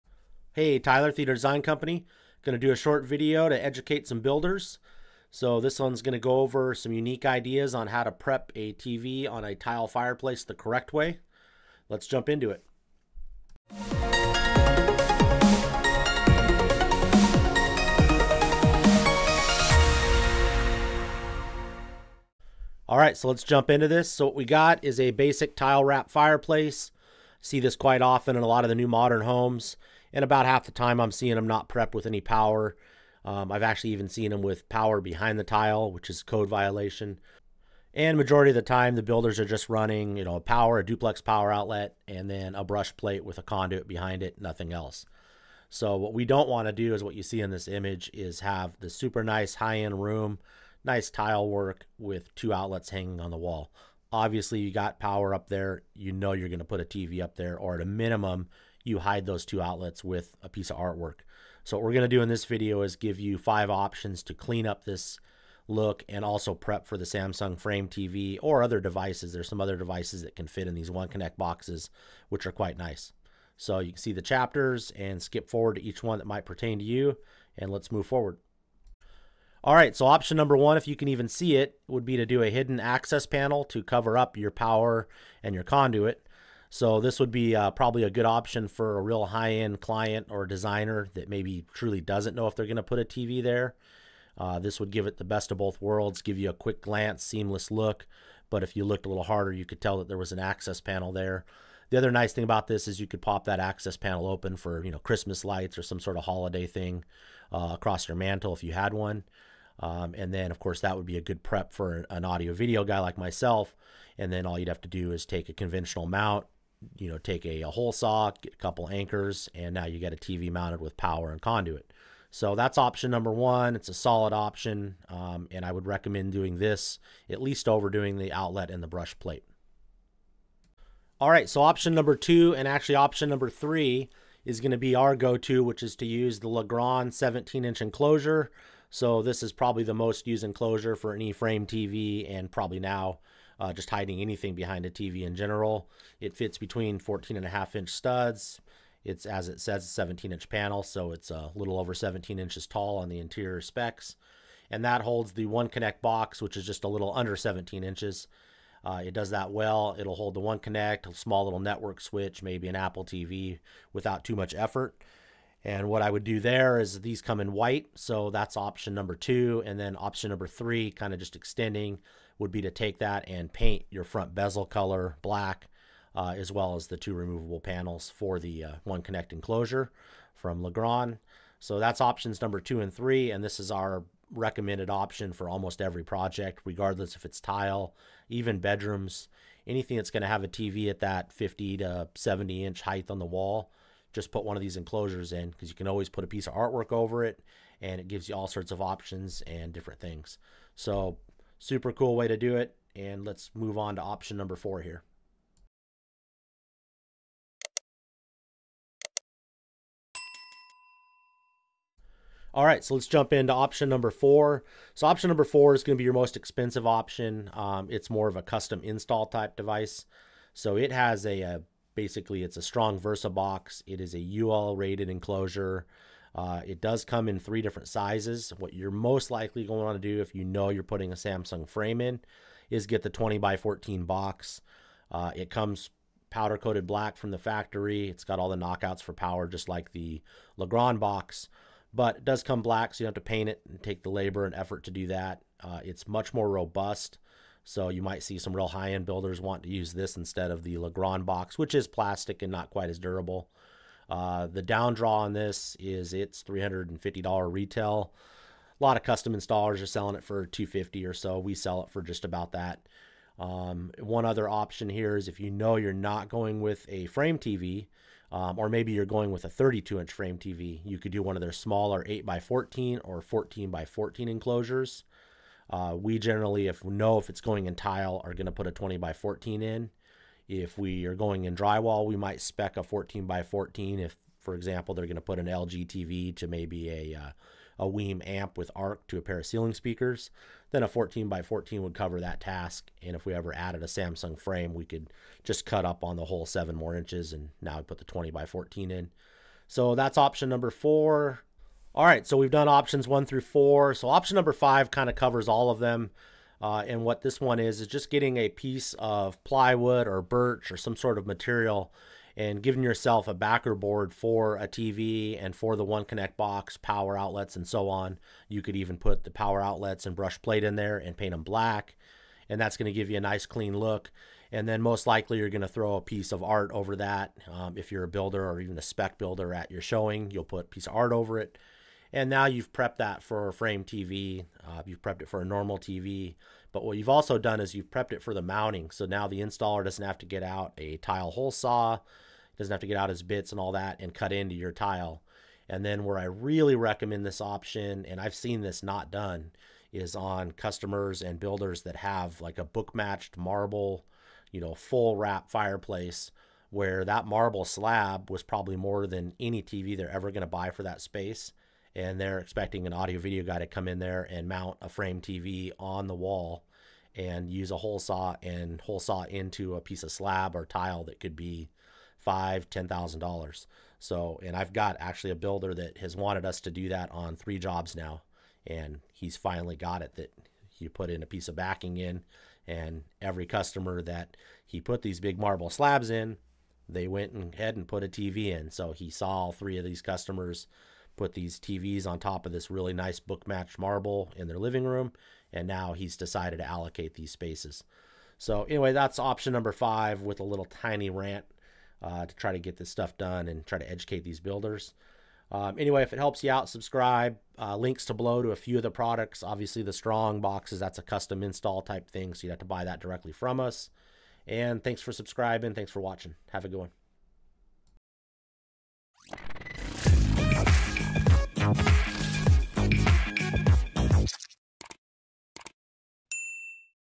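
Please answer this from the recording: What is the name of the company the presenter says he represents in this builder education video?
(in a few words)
Theater Design Company.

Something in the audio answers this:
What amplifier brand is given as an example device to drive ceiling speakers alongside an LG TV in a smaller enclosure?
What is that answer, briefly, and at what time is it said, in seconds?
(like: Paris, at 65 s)
WiiM, at 287 s.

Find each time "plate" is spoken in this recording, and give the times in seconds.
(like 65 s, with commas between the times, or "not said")
42 s, 129 s, 320 s.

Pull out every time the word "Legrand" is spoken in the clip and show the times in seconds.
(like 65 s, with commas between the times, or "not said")
136 s, 180 s, 240 s, 250 s.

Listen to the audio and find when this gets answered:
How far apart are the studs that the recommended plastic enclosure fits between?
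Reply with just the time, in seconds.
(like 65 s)
146 s.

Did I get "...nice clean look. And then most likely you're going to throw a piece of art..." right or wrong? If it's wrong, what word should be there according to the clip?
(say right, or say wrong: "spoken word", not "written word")
right.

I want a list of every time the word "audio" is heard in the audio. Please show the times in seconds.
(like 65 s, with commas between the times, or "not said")
112 s, 362 s.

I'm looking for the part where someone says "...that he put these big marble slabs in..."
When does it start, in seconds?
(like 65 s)
384 s.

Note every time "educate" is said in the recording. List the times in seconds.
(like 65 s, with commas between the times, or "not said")
3 s, 403 s.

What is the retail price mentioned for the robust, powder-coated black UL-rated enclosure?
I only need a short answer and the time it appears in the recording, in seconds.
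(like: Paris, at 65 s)
$350, at 256 s.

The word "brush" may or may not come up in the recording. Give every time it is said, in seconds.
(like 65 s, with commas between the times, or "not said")
42 s, 128 s, 320 s.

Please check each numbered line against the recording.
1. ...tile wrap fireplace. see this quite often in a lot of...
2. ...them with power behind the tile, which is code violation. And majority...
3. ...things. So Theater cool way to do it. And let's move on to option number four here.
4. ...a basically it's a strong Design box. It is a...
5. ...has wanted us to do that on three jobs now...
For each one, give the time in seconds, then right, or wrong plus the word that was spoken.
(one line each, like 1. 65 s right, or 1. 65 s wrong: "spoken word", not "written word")
1. 25 s right
2. 34 s right
3. 199 s wrong: "Super", not "Theater"
4. 221 s wrong: "Versa", not "Design"
5. 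375 s right.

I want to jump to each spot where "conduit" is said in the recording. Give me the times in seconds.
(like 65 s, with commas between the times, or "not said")
43 s, 85 s, 121 s.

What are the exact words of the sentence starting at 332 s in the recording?
And now you've prepped that for a frame TV.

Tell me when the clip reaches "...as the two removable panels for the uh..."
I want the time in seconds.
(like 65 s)
176 s.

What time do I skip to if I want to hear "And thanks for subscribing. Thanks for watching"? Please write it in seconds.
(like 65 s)
414 s.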